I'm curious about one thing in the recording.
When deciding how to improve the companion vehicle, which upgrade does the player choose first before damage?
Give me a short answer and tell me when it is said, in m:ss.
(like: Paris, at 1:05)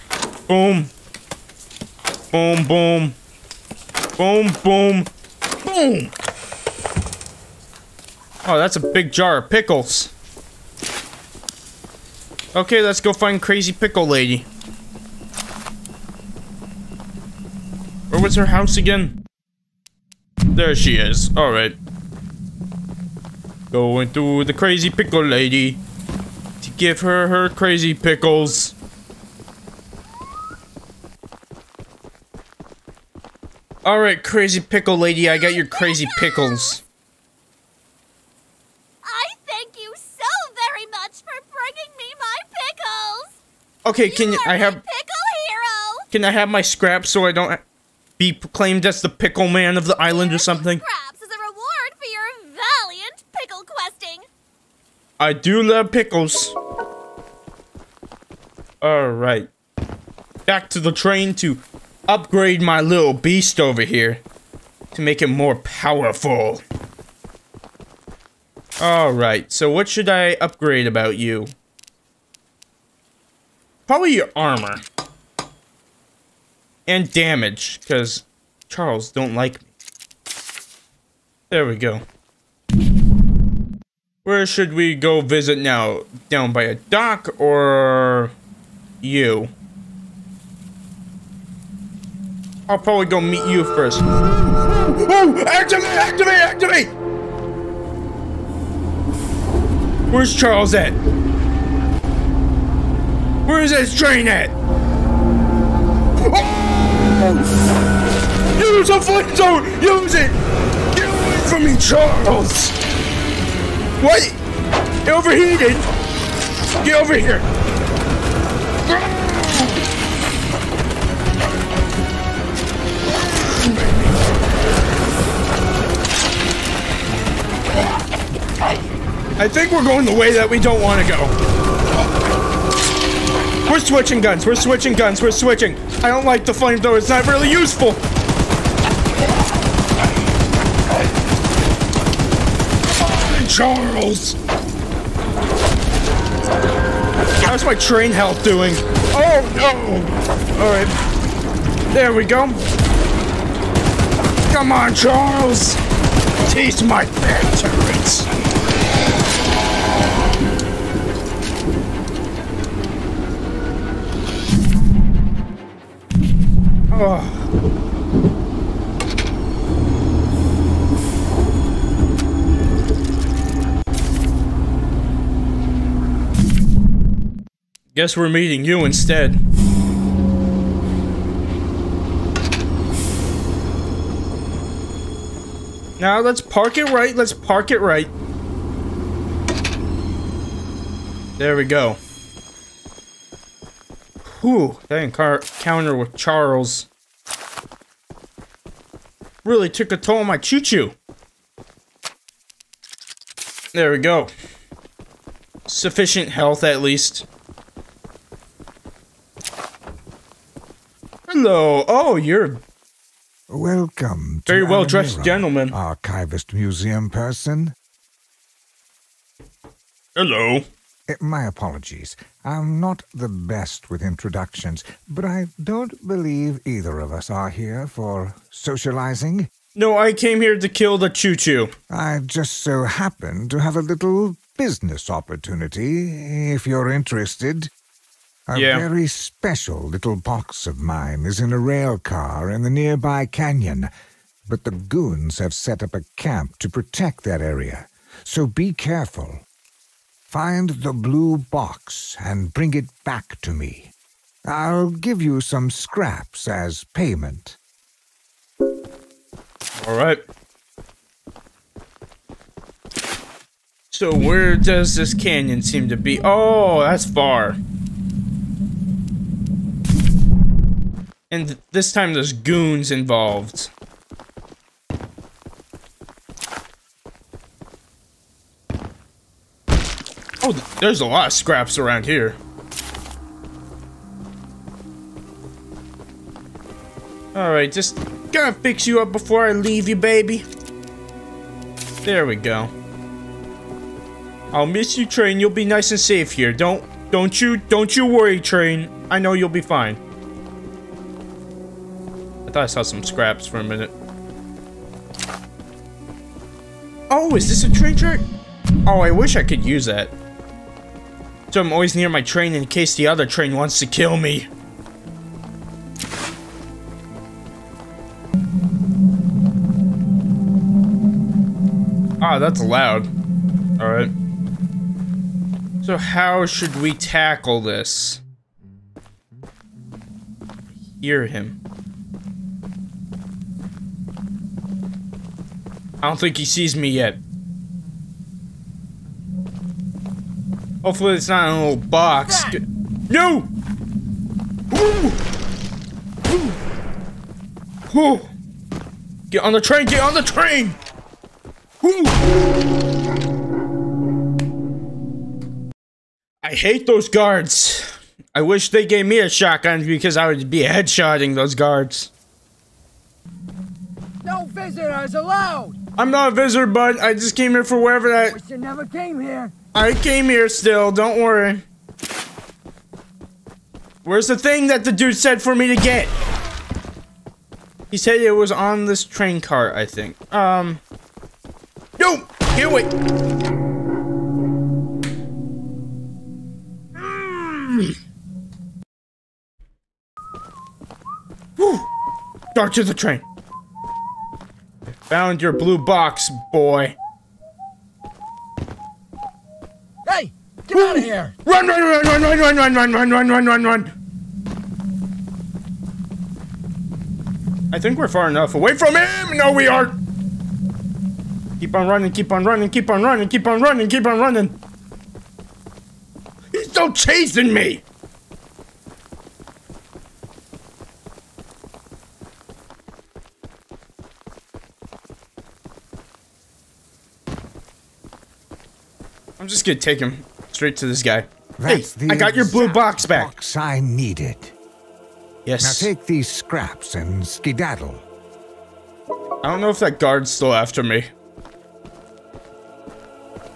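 Armor, at 1:13.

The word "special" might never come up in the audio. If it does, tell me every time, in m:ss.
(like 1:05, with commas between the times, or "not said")
3:59.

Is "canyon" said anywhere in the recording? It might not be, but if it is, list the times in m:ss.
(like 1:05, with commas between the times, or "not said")
4:03, 4:25.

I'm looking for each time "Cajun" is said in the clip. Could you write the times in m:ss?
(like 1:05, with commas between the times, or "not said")
not said.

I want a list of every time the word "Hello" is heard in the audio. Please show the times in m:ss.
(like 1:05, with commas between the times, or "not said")
3:31, 3:40.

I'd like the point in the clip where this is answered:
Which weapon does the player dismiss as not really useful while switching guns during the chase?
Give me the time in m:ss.
2:16.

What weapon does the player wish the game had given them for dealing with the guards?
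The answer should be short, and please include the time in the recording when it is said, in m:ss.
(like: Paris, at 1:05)
Shotgun, at 5:58.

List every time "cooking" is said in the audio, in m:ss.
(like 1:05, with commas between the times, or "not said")
not said.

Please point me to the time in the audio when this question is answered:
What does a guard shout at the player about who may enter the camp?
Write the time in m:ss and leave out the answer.
6:04.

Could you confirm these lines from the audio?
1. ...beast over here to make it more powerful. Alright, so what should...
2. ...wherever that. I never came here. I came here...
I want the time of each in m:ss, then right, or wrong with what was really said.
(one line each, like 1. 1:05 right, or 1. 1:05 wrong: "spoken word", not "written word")
1. 1:03 right
2. 6:07 right.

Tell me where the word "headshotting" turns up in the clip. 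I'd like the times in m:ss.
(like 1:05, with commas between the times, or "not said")
6:00.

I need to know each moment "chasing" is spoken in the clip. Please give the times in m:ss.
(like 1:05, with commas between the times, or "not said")
6:56.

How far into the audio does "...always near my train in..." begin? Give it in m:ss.
5:11.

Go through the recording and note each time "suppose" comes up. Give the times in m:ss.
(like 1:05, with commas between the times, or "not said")
not said.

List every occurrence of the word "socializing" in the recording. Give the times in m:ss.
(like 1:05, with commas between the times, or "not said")
3:48.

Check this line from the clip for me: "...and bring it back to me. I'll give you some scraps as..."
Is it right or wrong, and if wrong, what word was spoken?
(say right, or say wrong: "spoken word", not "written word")
right.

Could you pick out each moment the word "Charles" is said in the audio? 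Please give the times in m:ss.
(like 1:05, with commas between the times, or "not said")
1:18, 1:40, 1:51, 2:23, 2:34, 3:16.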